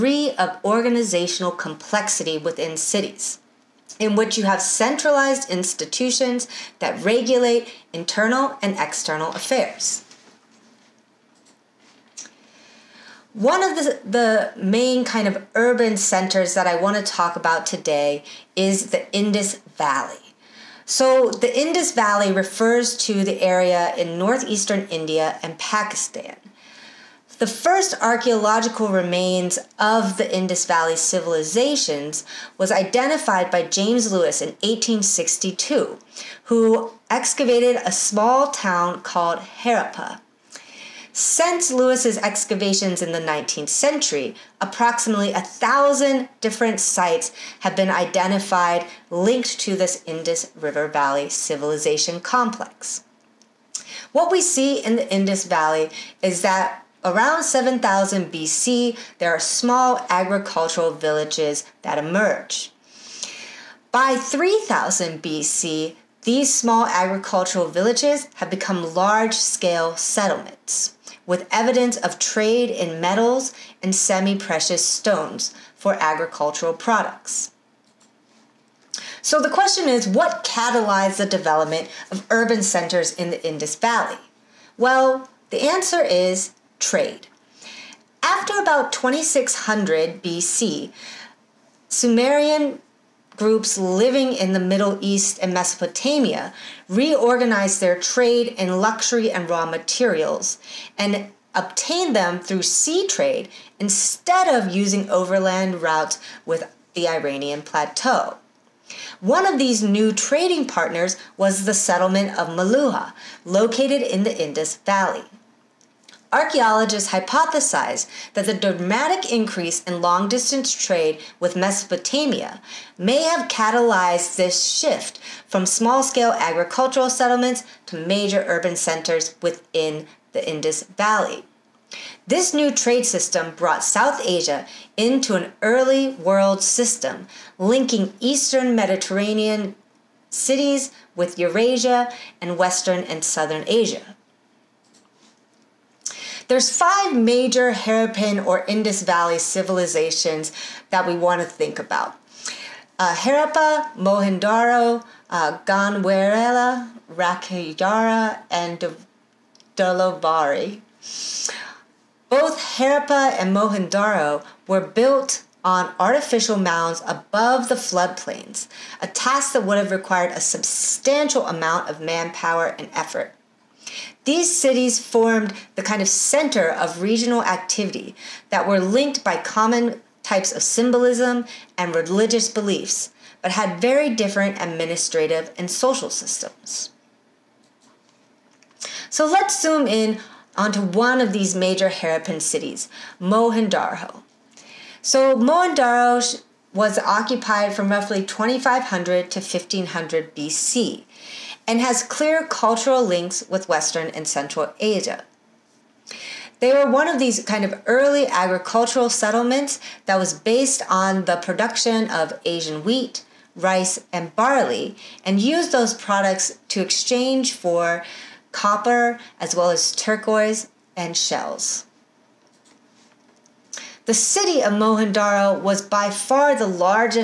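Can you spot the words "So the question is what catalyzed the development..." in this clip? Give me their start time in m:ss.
1:19.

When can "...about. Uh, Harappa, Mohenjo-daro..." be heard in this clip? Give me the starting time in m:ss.
2:31.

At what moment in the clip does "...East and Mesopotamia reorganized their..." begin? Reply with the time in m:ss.
1:35.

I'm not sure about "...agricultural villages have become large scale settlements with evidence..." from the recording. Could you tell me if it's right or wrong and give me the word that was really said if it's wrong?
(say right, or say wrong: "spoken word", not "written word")
right.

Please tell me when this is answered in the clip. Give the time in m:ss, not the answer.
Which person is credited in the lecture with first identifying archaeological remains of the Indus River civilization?
0:33.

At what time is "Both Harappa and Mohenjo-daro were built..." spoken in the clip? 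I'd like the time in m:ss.
2:42.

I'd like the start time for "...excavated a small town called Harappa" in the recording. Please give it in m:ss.
0:37.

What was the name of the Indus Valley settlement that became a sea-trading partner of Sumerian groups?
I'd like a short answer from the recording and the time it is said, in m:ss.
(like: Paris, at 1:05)
Meluhha, at 1:52.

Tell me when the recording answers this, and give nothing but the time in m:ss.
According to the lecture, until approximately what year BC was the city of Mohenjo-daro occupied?
3:19.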